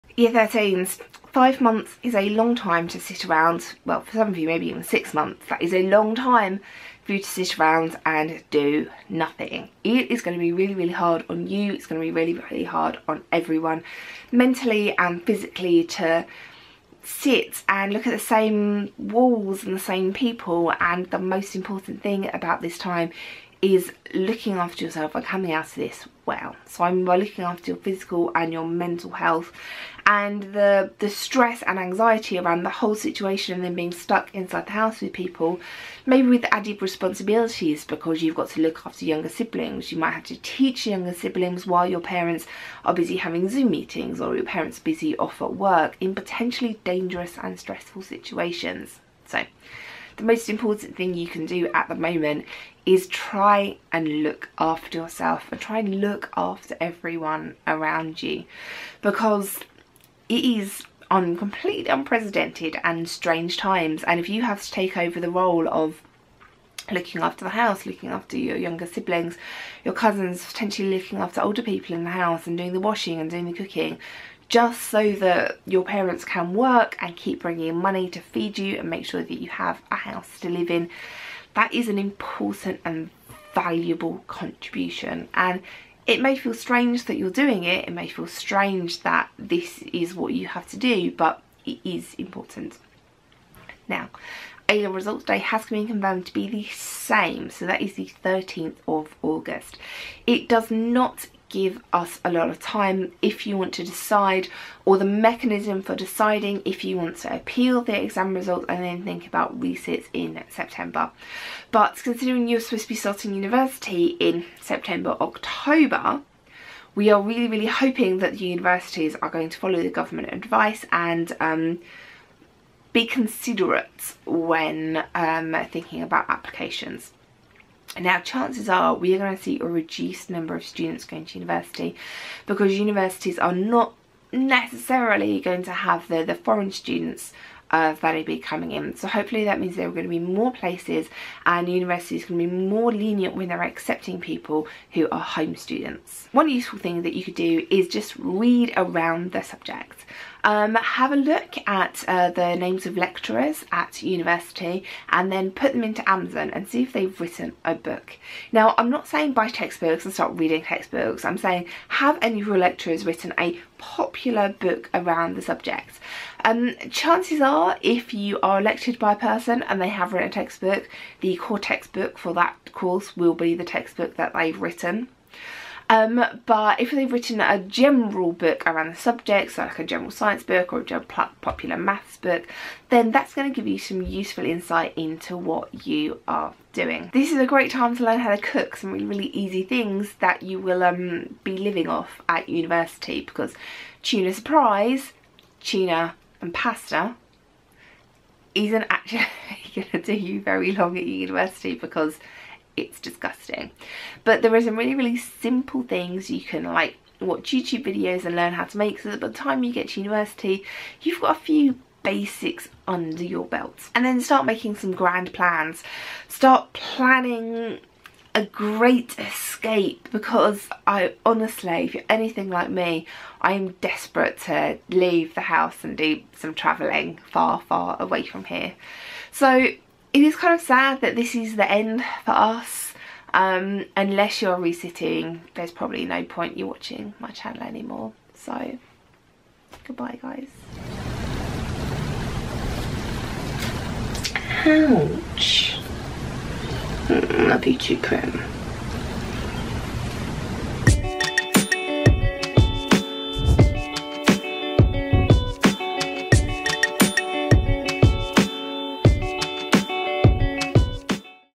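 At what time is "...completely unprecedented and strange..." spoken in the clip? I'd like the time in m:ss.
1:01.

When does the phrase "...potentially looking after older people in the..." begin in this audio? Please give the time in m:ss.
1:10.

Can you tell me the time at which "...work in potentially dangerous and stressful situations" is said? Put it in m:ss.
0:45.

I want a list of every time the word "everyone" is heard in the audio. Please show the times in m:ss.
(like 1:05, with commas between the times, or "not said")
0:13, 0:56.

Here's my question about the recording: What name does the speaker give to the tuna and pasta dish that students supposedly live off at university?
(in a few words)
Tuna surprise.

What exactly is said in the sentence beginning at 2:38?
Now, I'm not saying buy textbooks and start reading textbooks.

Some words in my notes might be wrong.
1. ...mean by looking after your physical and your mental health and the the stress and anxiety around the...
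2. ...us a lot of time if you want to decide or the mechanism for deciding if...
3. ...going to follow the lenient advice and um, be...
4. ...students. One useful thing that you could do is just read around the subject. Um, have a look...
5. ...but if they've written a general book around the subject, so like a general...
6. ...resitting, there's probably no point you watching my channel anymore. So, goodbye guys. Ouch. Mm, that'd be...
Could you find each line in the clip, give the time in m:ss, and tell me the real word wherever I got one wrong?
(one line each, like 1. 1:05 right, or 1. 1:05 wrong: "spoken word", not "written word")
1. 0:26 right
2. 1:41 right
3. 1:59 wrong: "government", not "lenient"
4. 2:25 right
5. 2:56 right
6. 3:54 right.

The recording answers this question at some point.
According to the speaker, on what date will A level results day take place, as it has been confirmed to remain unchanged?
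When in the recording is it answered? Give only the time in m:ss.
1:38.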